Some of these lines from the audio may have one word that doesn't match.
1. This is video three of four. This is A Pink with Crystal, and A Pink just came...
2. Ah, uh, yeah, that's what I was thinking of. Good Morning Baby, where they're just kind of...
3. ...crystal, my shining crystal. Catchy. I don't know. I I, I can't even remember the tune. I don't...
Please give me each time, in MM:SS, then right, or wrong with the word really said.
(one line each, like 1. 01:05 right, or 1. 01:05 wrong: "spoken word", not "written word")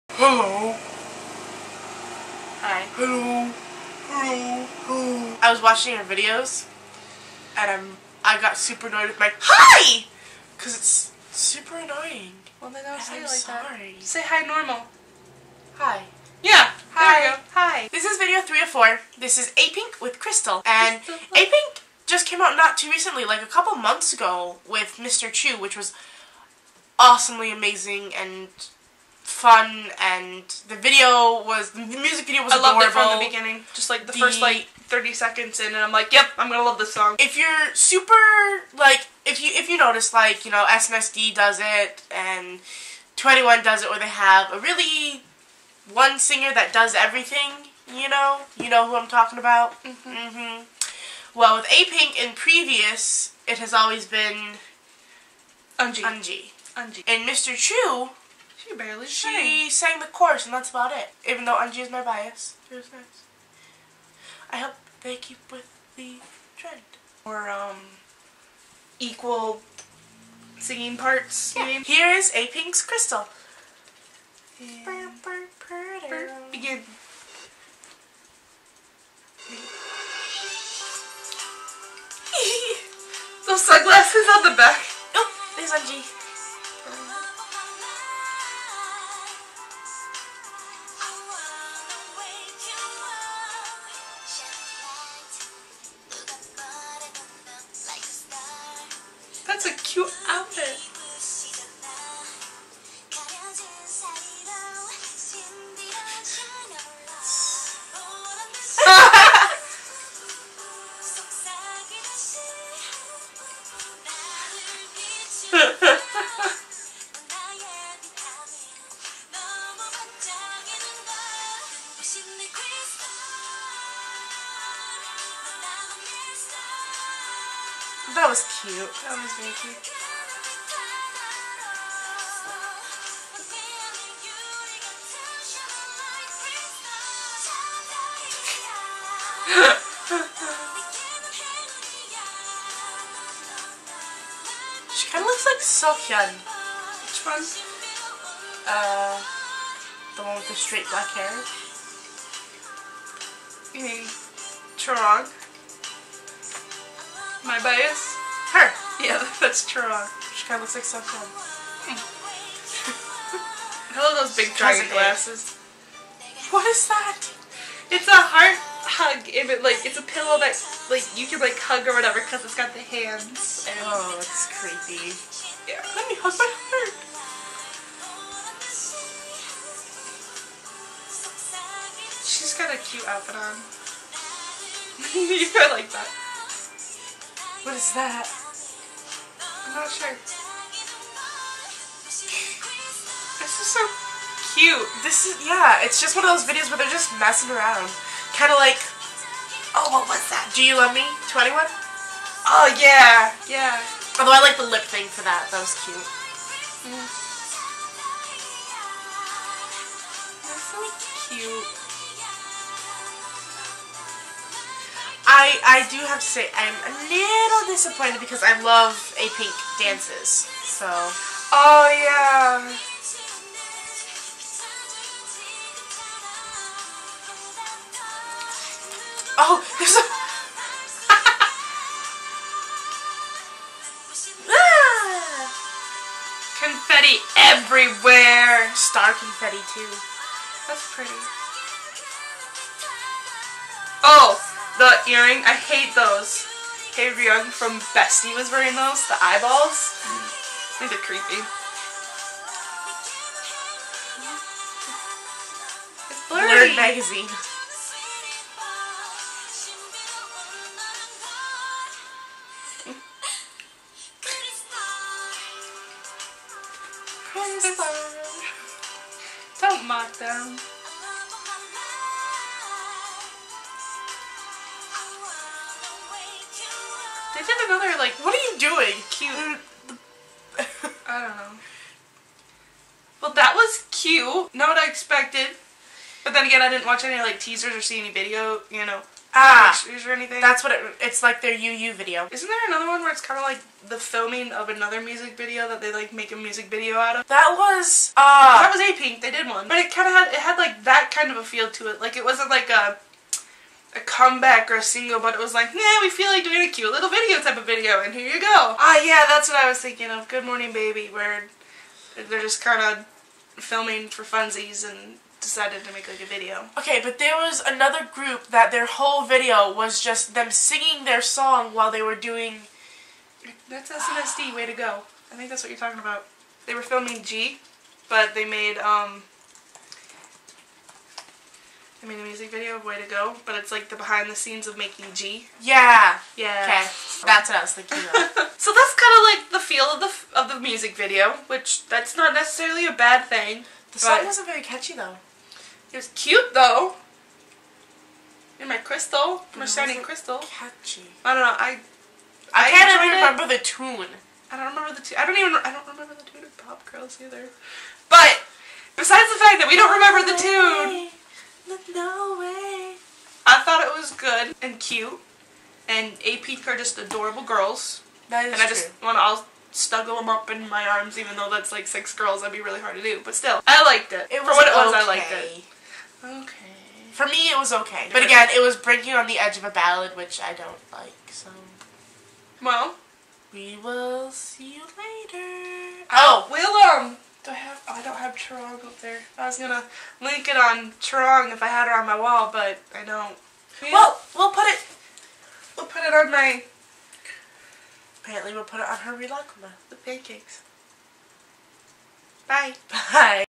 1. 00:17 right
2. 05:08 right
3. 05:48 right.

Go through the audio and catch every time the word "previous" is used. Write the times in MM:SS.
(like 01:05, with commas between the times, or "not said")
00:52.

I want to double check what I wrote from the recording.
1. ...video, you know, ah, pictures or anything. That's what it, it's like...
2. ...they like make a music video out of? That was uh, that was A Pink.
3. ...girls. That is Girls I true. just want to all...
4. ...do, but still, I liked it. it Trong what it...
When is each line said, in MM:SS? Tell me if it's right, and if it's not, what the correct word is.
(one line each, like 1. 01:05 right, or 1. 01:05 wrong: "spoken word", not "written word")
1. 04:48 right
2. 04:55 right
3. 06:07 wrong: "And", not "Girls"
4. 06:13 wrong: "For", not "Trong".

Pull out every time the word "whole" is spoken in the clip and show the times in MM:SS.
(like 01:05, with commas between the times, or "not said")
05:18.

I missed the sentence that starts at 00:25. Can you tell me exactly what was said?
Chu, which was awesomely amazing and fun and the video was the music video was I adorable.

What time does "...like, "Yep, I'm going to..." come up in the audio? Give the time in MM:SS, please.
00:35.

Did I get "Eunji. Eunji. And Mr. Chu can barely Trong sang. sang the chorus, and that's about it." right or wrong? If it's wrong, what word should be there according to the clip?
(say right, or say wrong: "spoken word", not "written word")
wrong: "She", not "Trong".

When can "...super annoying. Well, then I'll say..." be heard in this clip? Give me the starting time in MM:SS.
00:11.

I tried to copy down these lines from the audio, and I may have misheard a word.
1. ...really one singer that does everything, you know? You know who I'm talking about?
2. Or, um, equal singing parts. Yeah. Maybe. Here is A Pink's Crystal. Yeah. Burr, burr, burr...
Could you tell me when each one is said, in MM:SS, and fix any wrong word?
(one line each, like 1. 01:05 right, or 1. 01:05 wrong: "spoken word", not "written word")
1. 00:44 right
2. 01:07 right.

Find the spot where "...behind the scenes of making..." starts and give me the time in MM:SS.
05:33.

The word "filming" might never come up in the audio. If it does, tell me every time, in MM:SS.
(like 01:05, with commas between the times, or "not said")
04:53, 05:13, 05:26.